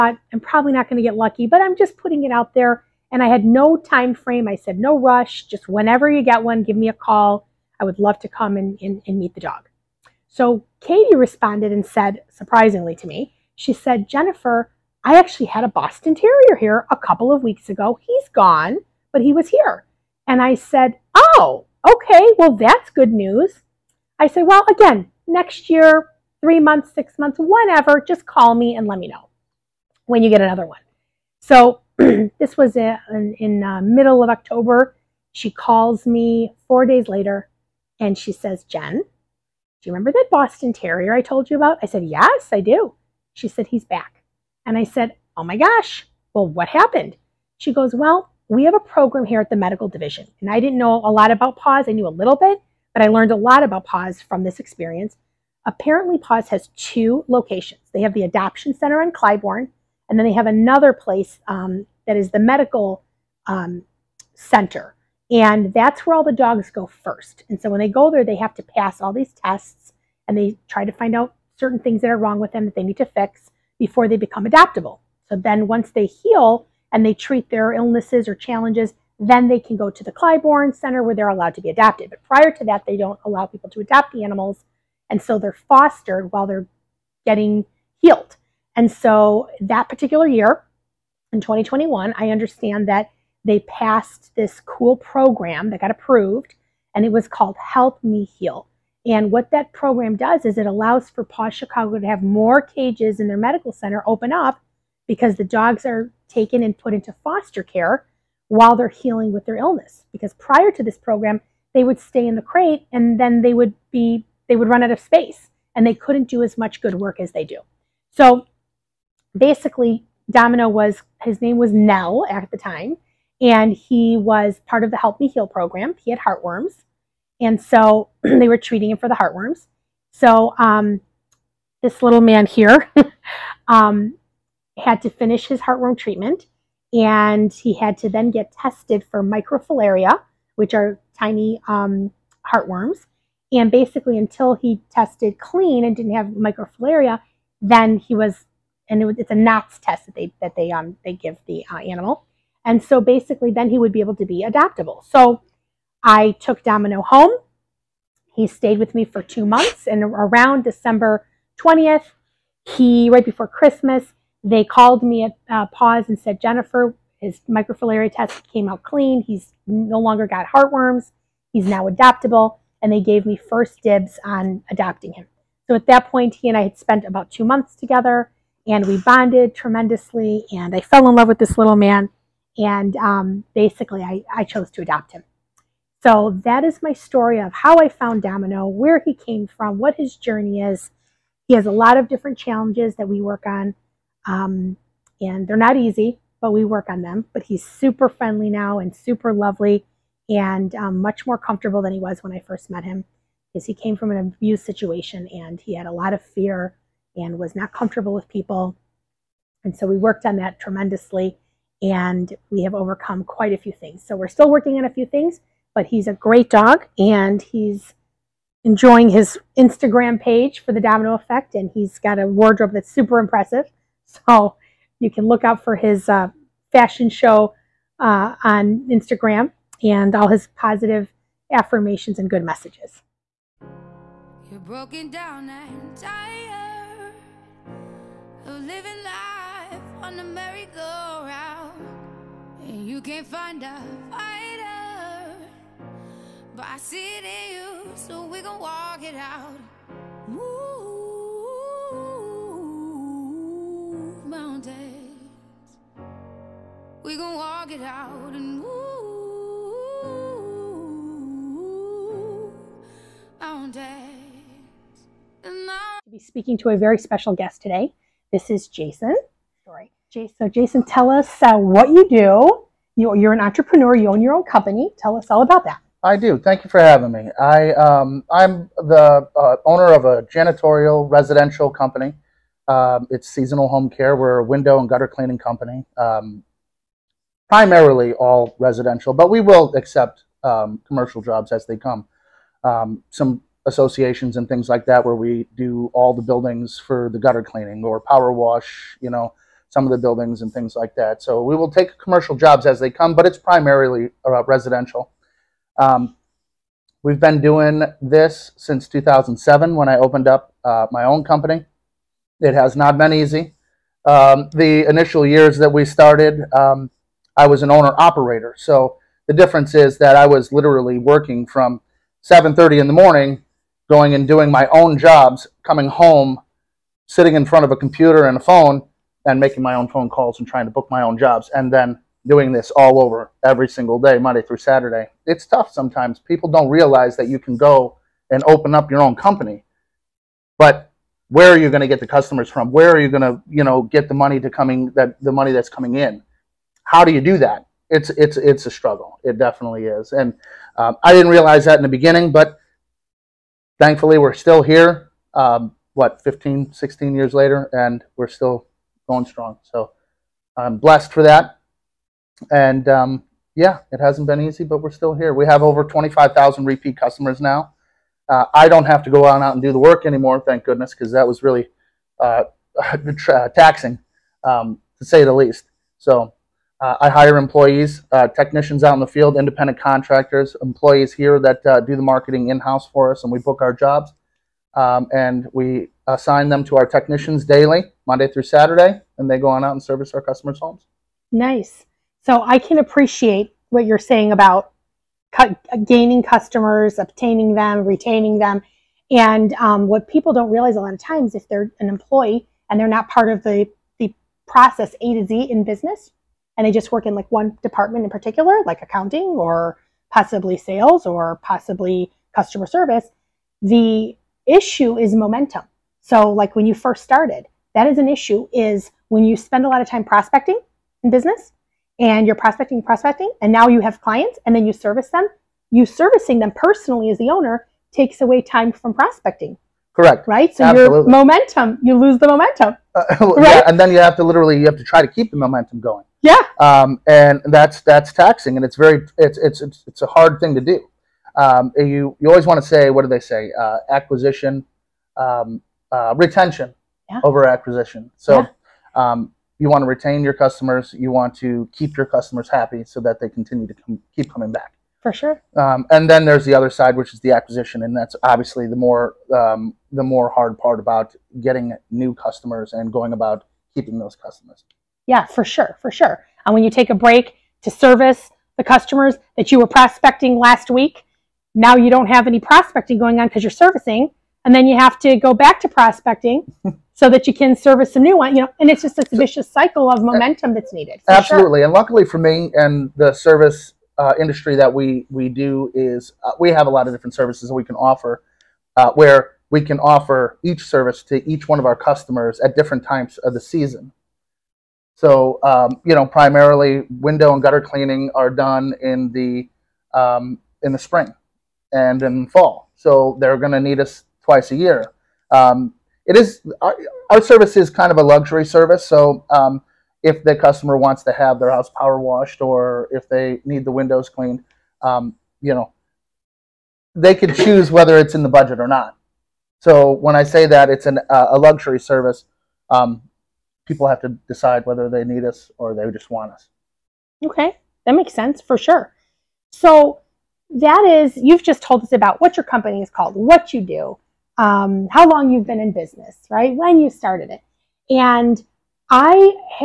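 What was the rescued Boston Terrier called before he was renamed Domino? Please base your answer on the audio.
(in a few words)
Nell.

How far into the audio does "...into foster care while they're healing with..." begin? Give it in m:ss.
1:46.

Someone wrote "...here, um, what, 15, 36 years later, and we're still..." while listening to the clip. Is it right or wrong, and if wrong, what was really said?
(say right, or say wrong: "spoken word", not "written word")
wrong: "16", not "36".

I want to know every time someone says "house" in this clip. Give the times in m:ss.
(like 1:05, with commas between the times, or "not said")
6:22, 8:31.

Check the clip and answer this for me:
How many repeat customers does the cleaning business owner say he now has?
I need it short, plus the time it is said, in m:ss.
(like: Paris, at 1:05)
Over 25,000, at 6:05.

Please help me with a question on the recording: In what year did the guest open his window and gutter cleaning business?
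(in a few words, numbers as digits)
2007.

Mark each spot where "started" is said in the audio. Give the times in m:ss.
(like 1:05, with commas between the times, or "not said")
5:15, 6:57, 8:56.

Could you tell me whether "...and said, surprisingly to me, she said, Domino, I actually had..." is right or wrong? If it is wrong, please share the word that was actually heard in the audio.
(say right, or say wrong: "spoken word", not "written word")
wrong: "Jennifer", not "Domino".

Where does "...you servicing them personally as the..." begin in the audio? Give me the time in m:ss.
7:05.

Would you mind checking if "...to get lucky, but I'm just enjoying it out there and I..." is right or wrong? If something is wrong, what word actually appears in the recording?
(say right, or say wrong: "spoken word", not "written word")
wrong: "putting", not "enjoying".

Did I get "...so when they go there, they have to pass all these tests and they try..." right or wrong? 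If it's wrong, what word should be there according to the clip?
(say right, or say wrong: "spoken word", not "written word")
right.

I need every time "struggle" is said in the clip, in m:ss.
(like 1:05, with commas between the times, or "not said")
5:48.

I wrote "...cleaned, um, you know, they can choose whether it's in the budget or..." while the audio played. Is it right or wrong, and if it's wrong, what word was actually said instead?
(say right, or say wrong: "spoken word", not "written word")
right.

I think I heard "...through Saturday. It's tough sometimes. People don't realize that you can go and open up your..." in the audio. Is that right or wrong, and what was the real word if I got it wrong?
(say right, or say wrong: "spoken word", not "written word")
right.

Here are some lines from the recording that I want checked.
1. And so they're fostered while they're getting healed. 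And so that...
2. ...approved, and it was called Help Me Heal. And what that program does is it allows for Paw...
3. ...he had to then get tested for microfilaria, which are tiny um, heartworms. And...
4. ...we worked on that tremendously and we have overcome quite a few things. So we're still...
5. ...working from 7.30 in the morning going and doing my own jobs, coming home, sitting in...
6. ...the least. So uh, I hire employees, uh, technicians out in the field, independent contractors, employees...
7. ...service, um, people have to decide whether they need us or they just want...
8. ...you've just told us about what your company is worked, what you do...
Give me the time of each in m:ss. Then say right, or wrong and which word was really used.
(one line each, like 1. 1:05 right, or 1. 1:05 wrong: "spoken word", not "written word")
1. 1:25 right
2. 1:35 right
3. 2:17 right
4. 3:29 right
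5. 5:20 right
6. 6:15 right
7. 8:41 right
8. 8:51 wrong: "called", not "worked".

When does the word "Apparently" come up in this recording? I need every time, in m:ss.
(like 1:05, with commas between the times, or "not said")
0:55.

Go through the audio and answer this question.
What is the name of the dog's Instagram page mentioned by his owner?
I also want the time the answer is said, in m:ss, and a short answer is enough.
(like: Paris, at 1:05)
The Domino Effect, at 3:40.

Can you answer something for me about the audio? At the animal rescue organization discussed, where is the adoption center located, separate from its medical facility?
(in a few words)
Clybourne.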